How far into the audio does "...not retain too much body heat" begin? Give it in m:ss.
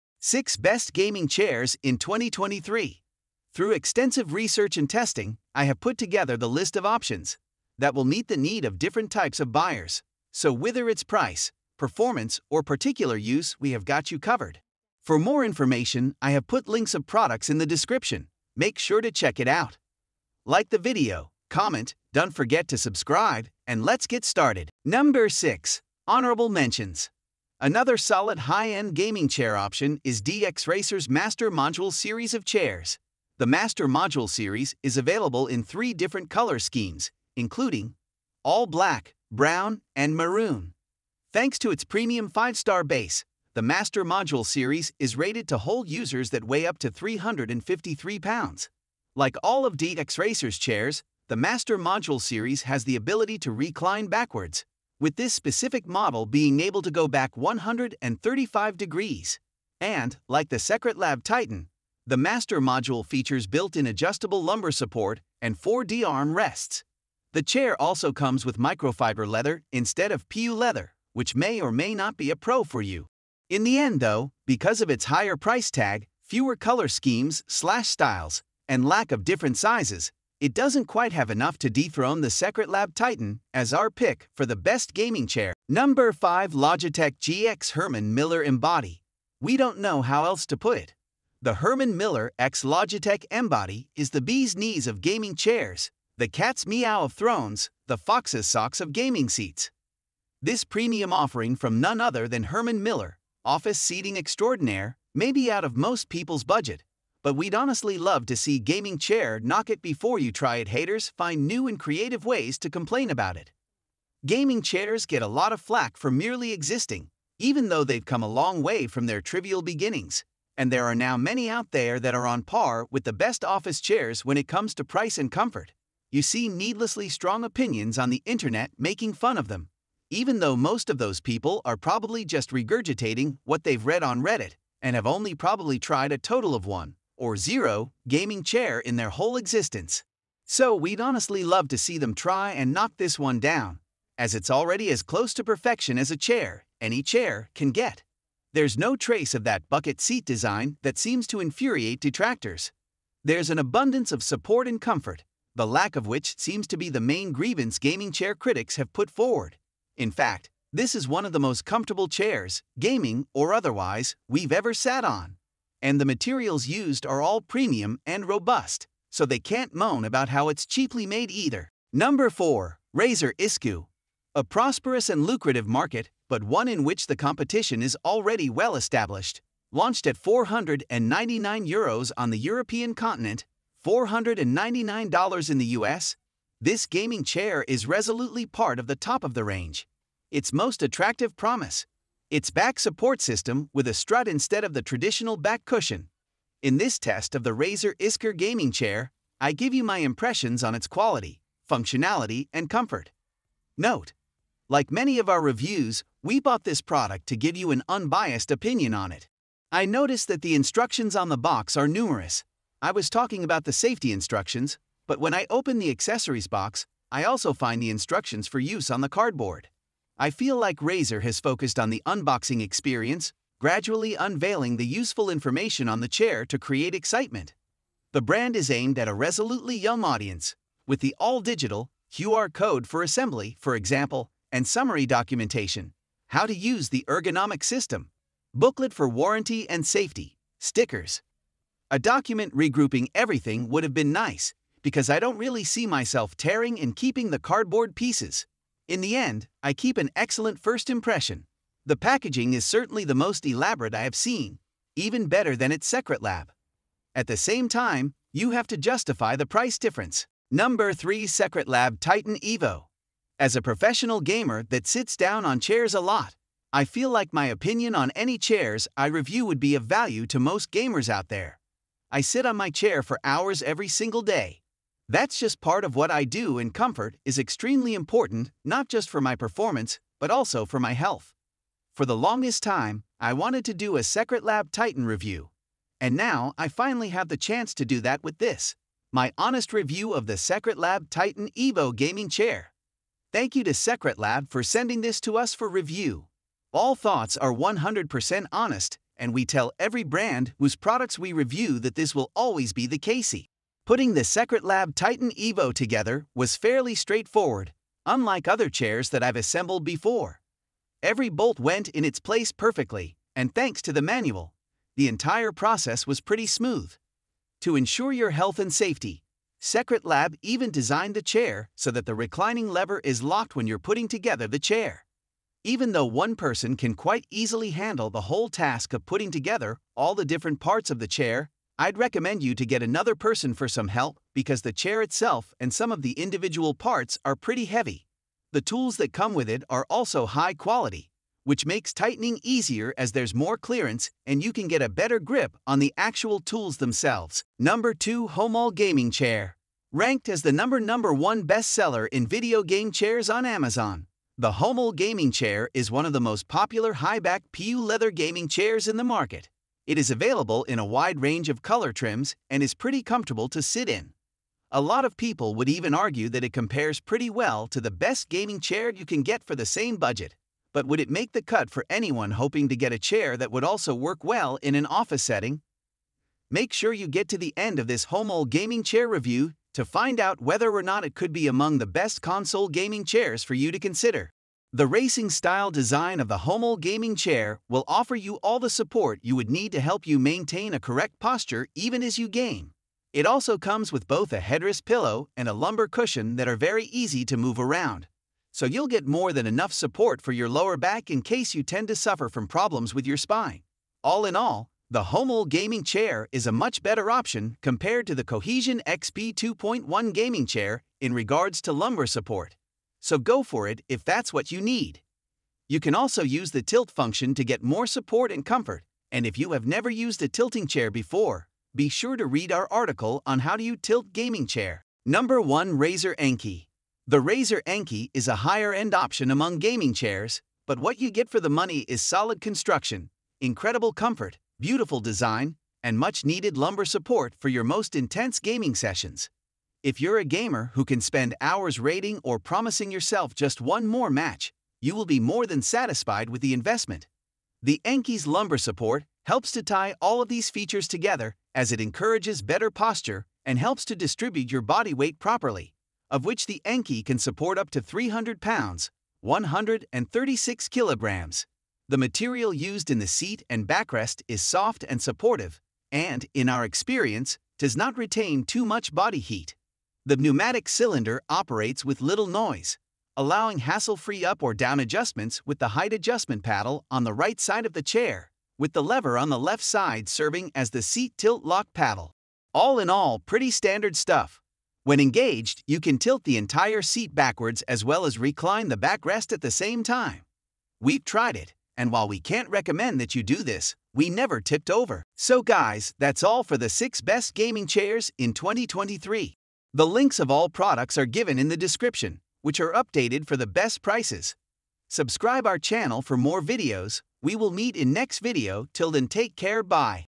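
7:47.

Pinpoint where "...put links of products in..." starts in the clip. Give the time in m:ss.
0:16.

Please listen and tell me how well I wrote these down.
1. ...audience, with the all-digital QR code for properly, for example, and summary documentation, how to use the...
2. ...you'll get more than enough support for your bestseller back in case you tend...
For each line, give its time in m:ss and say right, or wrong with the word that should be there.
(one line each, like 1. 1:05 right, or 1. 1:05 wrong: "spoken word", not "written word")
1. 3:50 wrong: "assembly", not "properly"
2. 6:38 wrong: "lower", not "bestseller".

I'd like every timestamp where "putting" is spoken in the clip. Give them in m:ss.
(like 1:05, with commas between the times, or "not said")
5:03, 5:23, 5:29.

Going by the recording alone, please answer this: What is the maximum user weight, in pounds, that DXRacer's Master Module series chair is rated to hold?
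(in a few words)
353 pounds.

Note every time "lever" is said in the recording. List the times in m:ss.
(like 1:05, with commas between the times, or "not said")
5:22, 7:58.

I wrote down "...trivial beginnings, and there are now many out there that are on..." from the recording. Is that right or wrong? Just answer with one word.
right.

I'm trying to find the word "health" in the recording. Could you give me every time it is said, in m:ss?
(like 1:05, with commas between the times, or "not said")
4:40, 5:18.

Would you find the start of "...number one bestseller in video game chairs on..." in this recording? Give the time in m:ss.
5:50.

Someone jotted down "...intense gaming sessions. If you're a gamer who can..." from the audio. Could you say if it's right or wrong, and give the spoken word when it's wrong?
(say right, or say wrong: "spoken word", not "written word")
right.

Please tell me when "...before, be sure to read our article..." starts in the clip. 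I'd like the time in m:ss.
7:00.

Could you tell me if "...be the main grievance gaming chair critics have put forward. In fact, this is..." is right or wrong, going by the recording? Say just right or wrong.
right.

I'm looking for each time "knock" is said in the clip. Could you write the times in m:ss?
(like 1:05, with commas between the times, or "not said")
1:49, 2:22.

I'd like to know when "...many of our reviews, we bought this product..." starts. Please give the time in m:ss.
3:24.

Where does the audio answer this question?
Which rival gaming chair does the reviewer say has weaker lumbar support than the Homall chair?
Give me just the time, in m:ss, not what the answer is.
6:48.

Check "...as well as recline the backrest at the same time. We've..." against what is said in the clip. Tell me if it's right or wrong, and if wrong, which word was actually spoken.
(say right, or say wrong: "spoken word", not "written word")
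right.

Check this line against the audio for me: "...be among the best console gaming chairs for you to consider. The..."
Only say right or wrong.
right.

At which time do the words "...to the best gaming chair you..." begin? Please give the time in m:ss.
6:07.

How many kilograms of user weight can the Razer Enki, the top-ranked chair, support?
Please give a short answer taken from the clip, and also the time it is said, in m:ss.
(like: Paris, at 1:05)
136 kilograms, at 7:39.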